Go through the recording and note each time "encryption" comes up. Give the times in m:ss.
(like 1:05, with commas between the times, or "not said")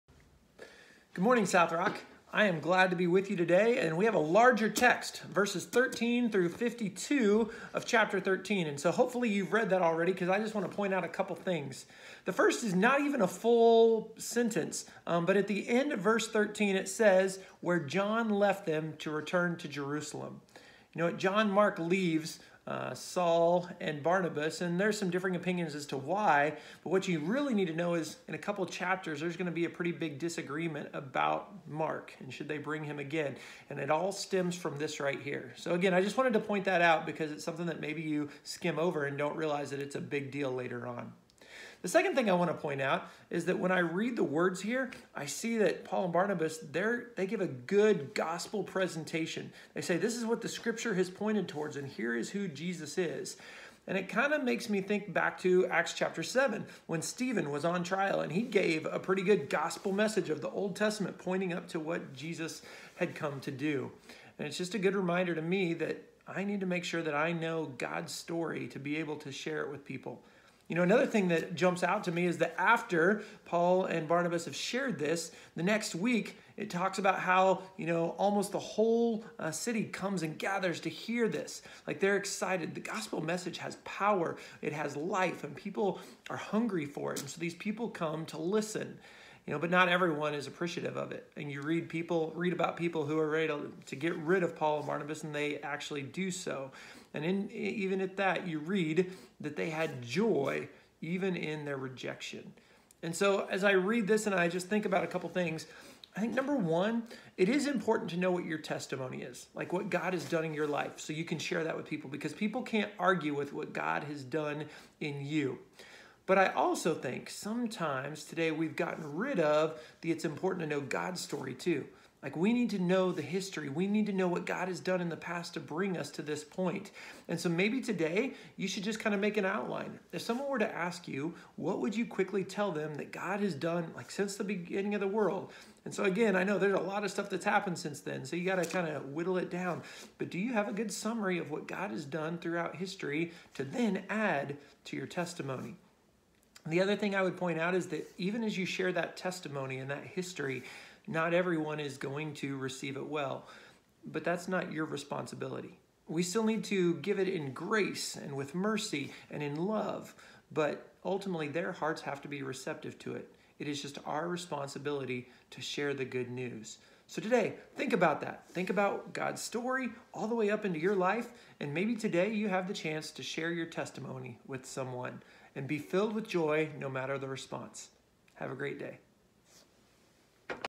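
not said.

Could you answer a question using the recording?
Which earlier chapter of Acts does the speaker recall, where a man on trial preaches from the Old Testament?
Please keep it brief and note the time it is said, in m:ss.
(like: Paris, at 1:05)
Acts chapter 7, at 0:55.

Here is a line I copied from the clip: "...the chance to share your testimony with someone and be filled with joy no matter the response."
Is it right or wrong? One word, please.
right.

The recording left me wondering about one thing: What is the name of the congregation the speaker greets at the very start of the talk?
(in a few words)
South Rock.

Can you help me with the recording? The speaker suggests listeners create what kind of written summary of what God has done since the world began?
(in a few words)
An outline.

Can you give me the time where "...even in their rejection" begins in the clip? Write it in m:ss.
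1:41.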